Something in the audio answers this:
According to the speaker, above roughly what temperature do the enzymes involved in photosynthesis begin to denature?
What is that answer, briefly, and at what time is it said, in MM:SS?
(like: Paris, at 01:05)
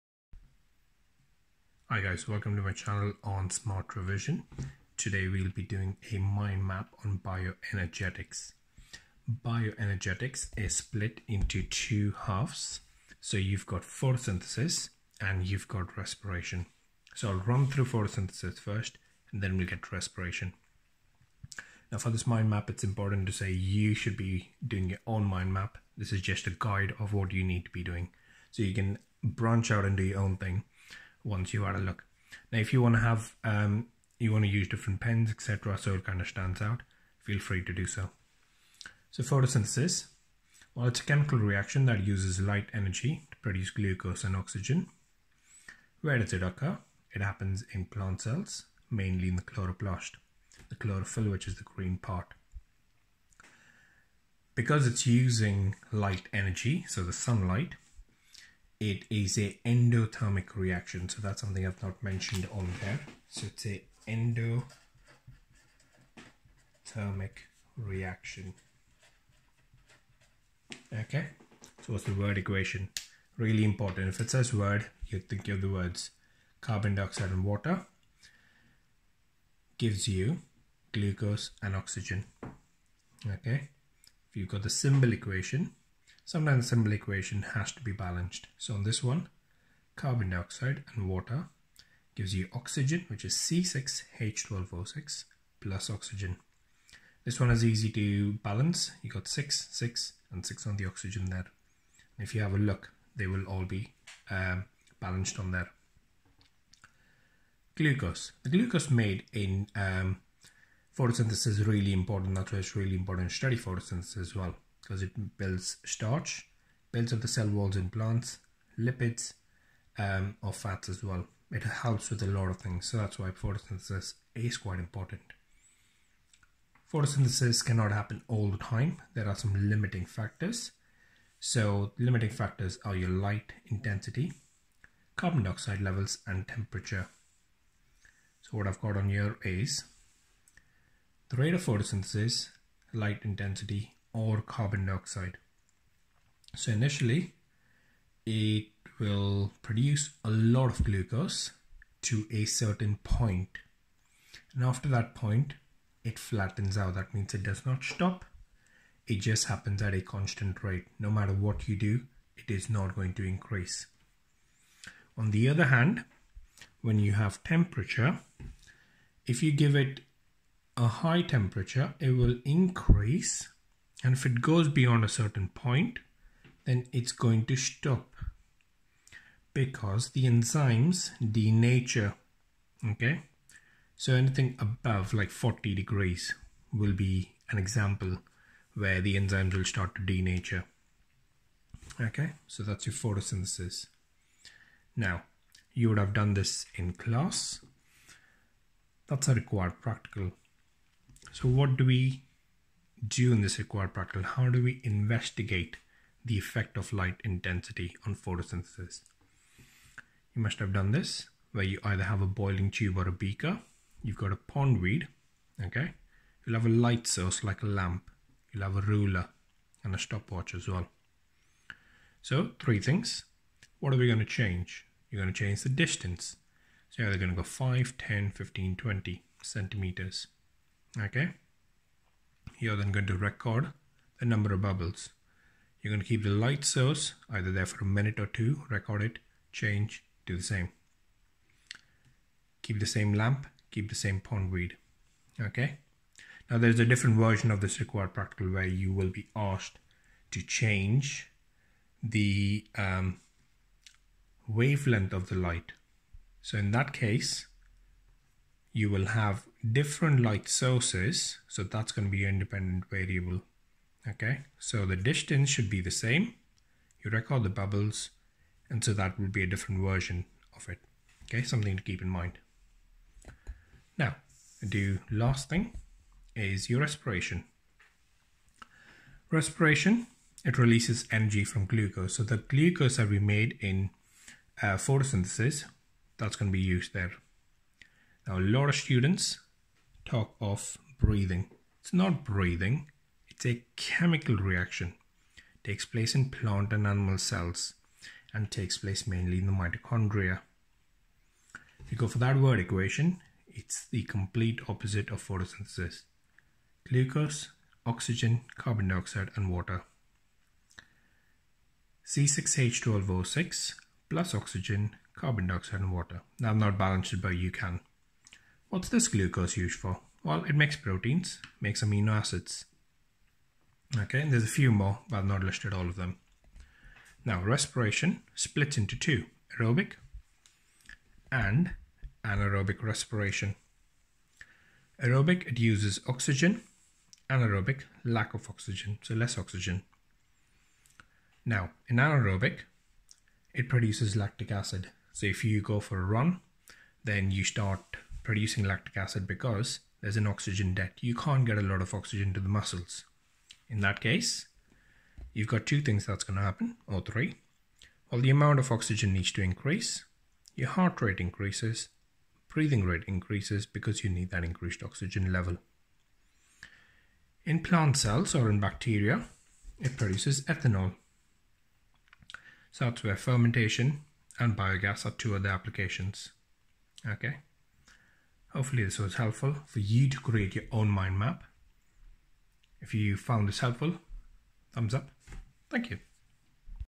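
40 degrees, at 03:05.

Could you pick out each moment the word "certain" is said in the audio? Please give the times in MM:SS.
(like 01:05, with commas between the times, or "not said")
02:32, 02:55.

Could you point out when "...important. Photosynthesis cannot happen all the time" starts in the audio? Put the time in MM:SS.
02:04.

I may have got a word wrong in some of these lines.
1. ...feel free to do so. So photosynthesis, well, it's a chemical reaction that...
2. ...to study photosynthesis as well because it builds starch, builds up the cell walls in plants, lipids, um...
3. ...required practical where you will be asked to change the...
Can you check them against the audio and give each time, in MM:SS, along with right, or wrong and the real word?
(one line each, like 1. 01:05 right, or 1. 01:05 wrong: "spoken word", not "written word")
1. 00:37 right
2. 01:53 right
3. 04:07 right.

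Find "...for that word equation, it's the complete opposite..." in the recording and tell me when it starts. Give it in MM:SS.
05:02.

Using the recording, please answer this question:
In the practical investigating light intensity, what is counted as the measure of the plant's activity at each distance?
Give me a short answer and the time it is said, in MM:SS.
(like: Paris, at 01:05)
number of bubbles, at 03:54.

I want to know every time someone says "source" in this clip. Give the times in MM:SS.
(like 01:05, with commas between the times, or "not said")
03:37, 03:56, 04:20.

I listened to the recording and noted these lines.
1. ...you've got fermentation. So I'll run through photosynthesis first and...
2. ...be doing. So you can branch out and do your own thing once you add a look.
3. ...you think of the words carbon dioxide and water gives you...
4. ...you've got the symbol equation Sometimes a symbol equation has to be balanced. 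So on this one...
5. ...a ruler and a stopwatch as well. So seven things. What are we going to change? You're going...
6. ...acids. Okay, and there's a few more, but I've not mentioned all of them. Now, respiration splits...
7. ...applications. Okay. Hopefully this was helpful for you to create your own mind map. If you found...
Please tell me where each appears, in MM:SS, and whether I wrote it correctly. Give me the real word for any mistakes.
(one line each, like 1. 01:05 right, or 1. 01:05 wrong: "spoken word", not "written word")
1. 00:15 wrong: "respiration", not "fermentation"
2. 00:27 right
3. 01:15 right
4. 01:24 right
5. 03:38 wrong: "three", not "seven"
6. 05:22 wrong: "listed", not "mentioned"
7. 06:15 right.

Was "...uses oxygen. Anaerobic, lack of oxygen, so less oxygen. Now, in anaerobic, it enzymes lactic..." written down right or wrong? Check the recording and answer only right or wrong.
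wrong.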